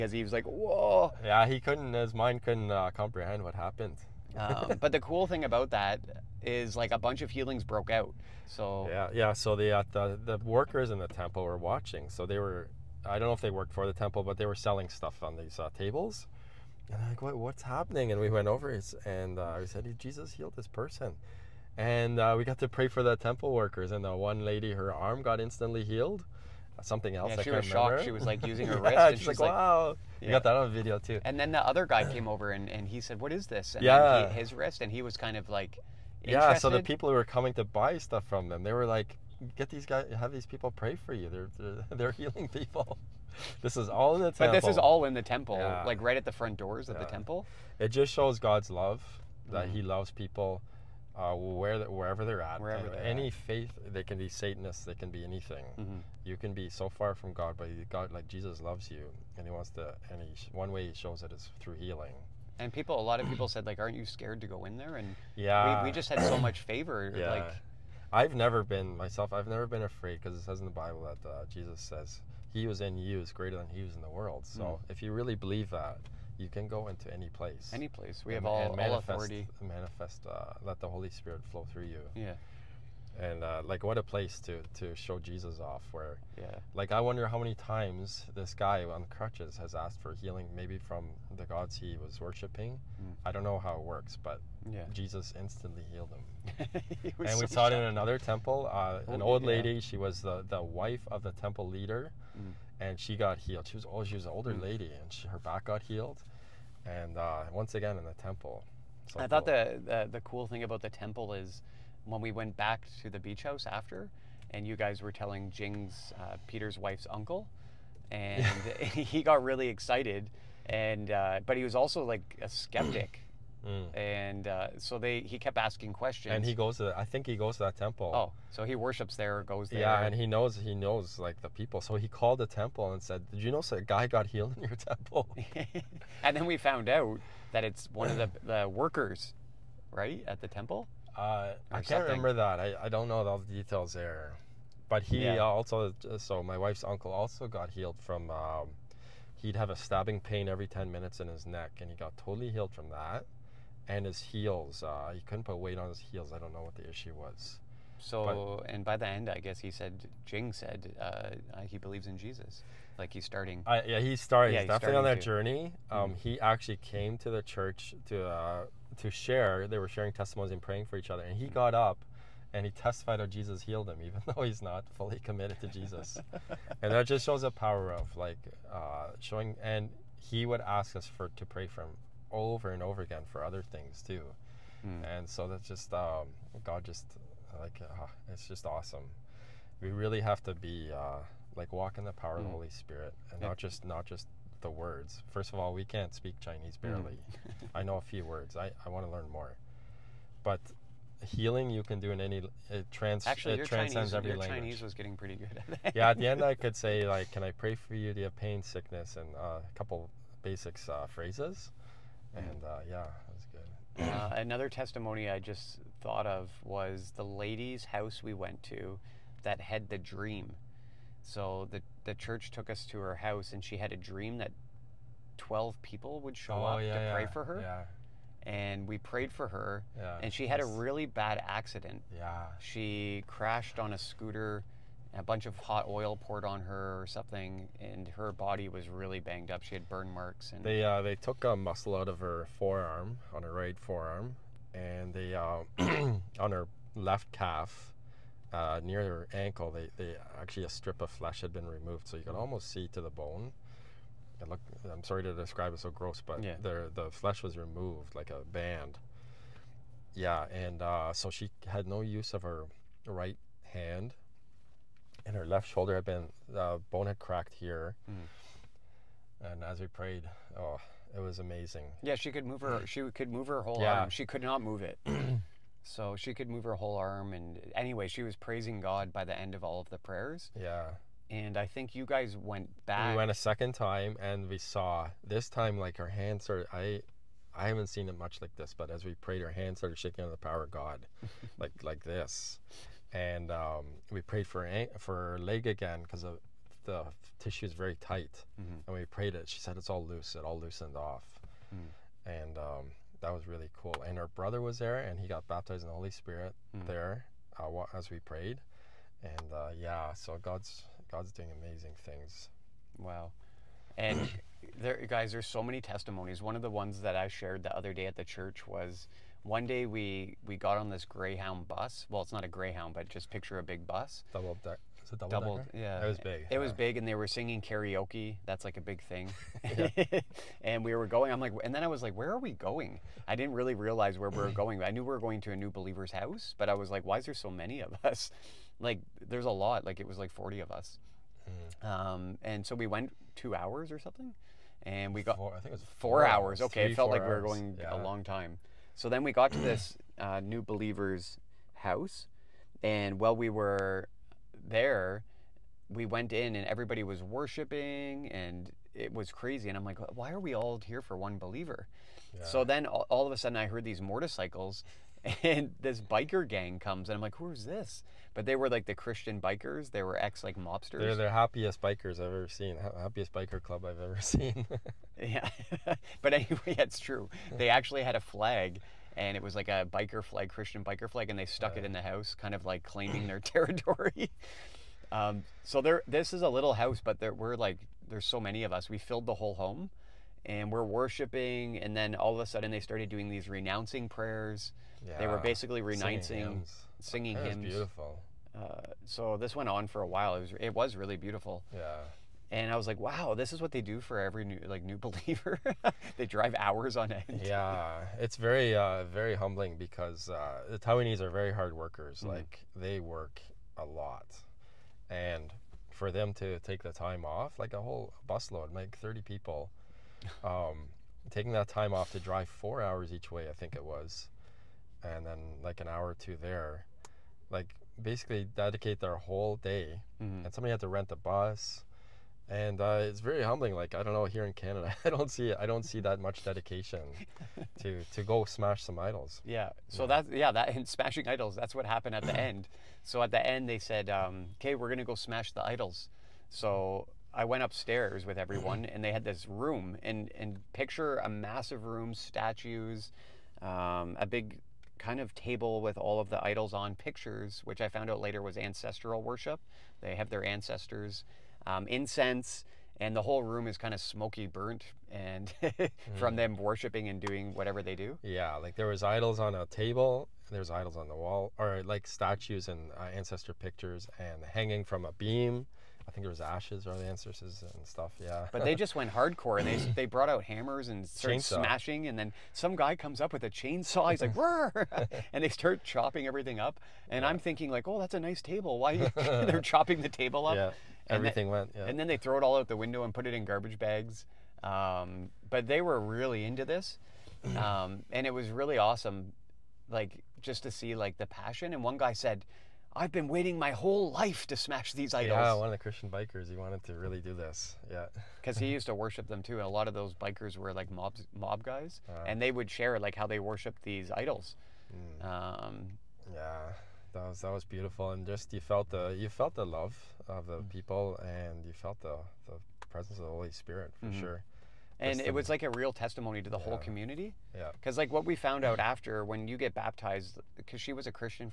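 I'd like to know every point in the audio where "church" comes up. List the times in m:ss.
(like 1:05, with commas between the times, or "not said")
2:47, 3:42, 5:18.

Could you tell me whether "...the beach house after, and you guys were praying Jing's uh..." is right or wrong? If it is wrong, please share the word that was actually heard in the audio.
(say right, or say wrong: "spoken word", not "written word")
wrong: "telling", not "praying".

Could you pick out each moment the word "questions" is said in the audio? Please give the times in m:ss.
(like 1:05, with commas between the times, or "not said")
2:05.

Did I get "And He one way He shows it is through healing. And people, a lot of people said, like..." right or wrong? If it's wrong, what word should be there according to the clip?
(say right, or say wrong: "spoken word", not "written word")
right.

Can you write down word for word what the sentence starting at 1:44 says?
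lady, and she, her back got healed, and uh, once again in the temple.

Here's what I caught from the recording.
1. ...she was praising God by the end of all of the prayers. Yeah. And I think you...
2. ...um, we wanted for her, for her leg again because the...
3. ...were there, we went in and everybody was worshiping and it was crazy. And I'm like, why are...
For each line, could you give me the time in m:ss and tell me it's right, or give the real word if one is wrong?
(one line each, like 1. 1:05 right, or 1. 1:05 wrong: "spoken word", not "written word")
1. 4:38 right
2. 4:53 wrong: "prayed", not "wanted"
3. 5:53 right.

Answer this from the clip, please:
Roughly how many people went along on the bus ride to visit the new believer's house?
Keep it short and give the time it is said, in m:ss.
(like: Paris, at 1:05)
40, at 5:40.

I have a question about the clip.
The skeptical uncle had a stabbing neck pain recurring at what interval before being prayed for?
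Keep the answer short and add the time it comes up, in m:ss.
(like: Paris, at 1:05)
Every 10 minutes, at 2:30.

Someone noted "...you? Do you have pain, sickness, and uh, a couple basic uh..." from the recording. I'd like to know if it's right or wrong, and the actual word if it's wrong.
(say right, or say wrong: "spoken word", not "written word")
right.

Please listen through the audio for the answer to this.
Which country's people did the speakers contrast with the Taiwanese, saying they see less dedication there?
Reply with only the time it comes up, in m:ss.
7:14.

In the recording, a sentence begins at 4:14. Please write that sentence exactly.
It looked, I'm sorry to describe it so gross, but yeah.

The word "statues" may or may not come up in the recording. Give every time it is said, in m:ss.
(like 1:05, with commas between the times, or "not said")
7:32, 7:52.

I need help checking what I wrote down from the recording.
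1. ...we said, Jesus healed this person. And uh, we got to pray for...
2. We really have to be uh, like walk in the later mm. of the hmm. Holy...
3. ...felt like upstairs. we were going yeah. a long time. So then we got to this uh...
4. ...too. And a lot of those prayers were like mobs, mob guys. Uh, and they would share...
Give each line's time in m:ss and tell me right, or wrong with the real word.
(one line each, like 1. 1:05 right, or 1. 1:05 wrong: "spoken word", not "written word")
1. 0:19 right
2. 3:09 wrong: "power", not "later"
3. 5:46 wrong: "hours", not "upstairs"
4. 8:29 wrong: "bikers", not "prayers".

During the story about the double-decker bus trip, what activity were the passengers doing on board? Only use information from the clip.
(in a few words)
Singing karaoke.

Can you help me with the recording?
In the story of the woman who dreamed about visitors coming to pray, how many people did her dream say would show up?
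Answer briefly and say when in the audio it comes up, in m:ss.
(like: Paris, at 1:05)
12, at 3:45.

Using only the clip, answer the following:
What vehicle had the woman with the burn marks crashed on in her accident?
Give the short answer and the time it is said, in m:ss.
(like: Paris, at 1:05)
Scooter, at 3:53.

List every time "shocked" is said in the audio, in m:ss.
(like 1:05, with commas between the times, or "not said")
0:27, 1:37.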